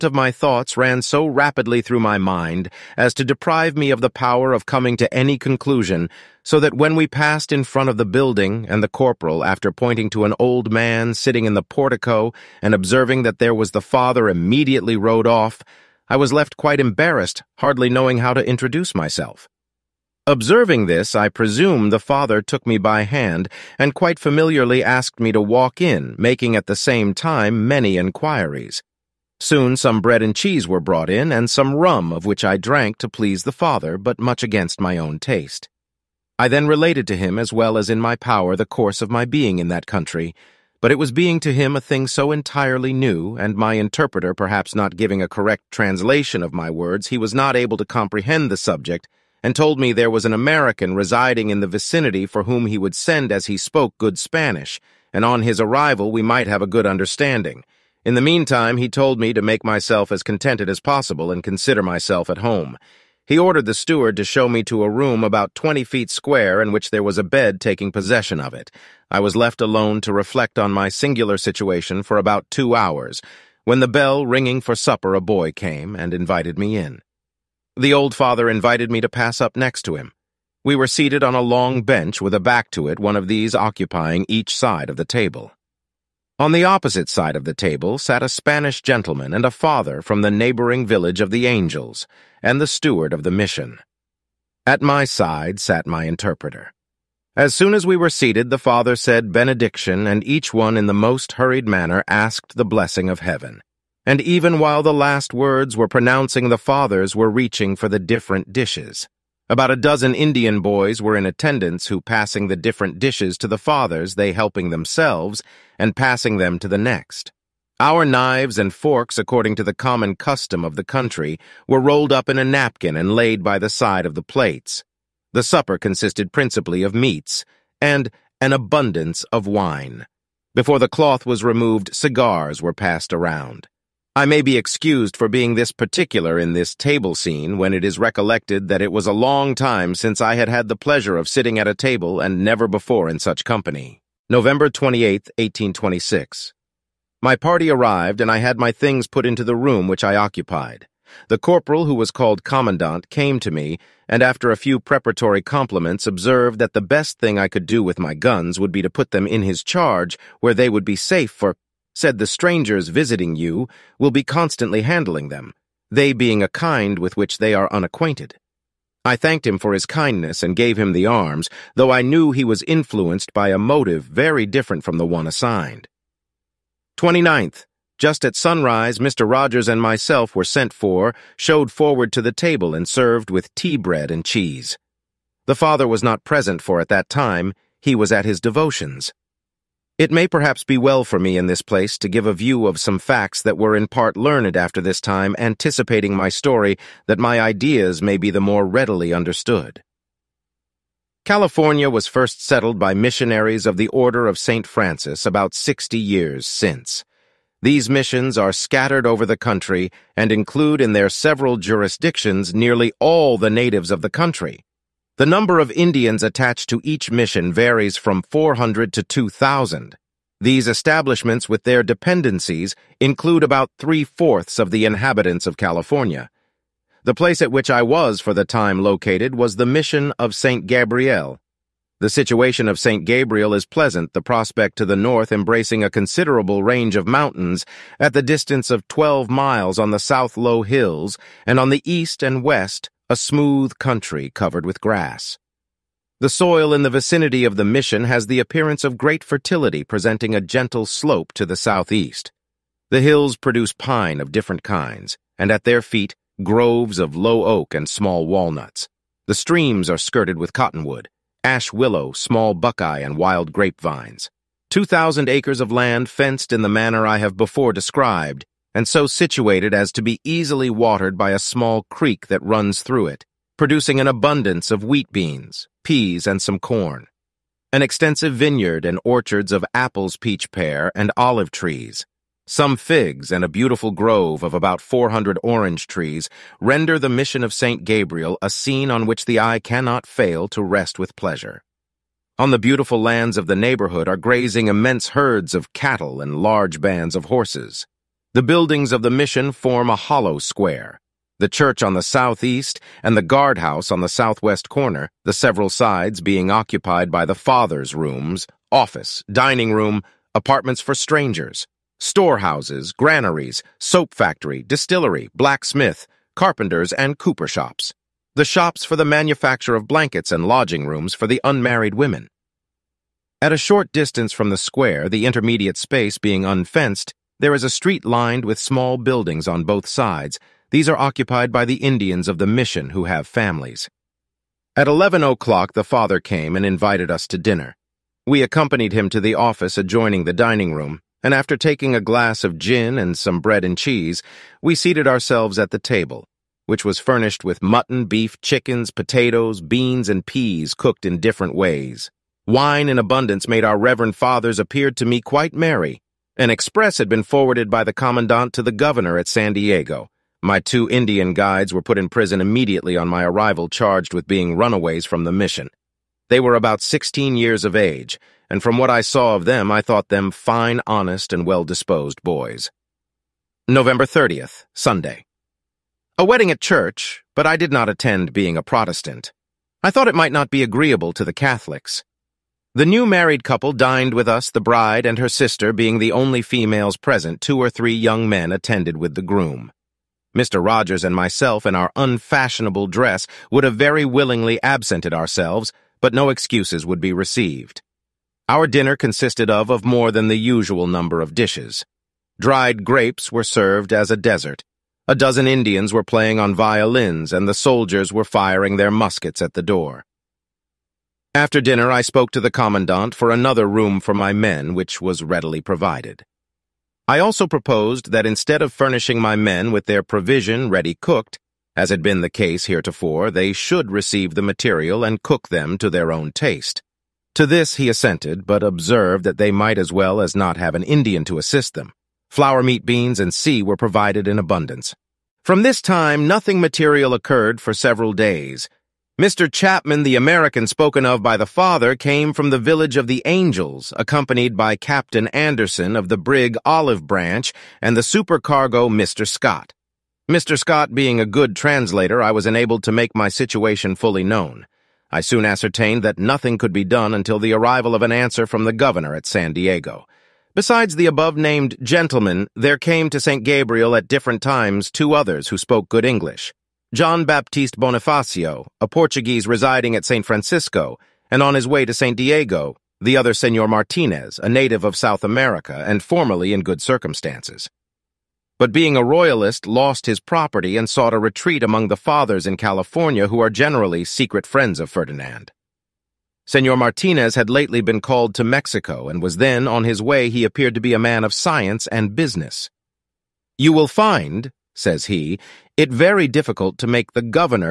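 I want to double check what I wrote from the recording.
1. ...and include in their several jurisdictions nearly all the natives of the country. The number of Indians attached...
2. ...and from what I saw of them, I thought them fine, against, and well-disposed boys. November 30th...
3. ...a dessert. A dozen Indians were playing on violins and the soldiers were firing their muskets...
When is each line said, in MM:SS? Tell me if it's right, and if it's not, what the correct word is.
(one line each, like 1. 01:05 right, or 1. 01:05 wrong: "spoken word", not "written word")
1. 03:30 right
2. 06:08 wrong: "honest", not "against"
3. 06:44 right.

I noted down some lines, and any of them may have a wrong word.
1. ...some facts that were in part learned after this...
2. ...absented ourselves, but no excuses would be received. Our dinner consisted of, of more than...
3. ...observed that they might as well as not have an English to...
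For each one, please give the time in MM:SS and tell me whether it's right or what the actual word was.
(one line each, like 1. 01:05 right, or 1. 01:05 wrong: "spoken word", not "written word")
1. 03:12 right
2. 06:34 right
3. 07:08 wrong: "Indian", not "English".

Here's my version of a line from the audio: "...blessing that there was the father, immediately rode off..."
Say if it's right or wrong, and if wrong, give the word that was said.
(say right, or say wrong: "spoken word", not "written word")
wrong: "observing", not "blessing".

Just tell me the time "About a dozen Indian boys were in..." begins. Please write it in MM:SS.
01:49.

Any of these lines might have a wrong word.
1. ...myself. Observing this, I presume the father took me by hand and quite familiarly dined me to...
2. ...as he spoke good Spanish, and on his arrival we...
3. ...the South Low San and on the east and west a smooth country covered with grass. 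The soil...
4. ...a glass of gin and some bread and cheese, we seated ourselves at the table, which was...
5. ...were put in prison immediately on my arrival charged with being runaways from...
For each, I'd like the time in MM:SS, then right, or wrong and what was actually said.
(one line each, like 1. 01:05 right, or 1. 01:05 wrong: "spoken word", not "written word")
1. 00:18 wrong: "asked", not "dined"
2. 00:53 right
3. 03:59 wrong: "Hills", not "San"
4. 05:41 right
5. 06:01 right.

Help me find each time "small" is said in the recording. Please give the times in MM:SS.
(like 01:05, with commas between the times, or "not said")
04:17, 04:22, 04:31, 05:28.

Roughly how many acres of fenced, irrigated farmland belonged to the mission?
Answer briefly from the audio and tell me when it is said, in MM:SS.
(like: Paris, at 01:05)
2,000, at 04:24.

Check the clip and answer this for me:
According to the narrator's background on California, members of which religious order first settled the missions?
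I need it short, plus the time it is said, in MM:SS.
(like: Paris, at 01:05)
St. Francis, at 03:23.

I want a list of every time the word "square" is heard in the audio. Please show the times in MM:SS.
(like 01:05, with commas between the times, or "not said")
01:06, 05:00, 05:24.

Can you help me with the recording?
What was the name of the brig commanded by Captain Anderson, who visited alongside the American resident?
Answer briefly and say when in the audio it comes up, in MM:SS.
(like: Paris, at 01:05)
Olive Branch, at 07:26.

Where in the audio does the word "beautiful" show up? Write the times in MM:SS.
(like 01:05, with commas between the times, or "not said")
04:43, 04:52.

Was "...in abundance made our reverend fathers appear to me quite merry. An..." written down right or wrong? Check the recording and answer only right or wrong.
right.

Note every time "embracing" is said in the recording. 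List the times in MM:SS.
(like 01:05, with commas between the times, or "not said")
03:55.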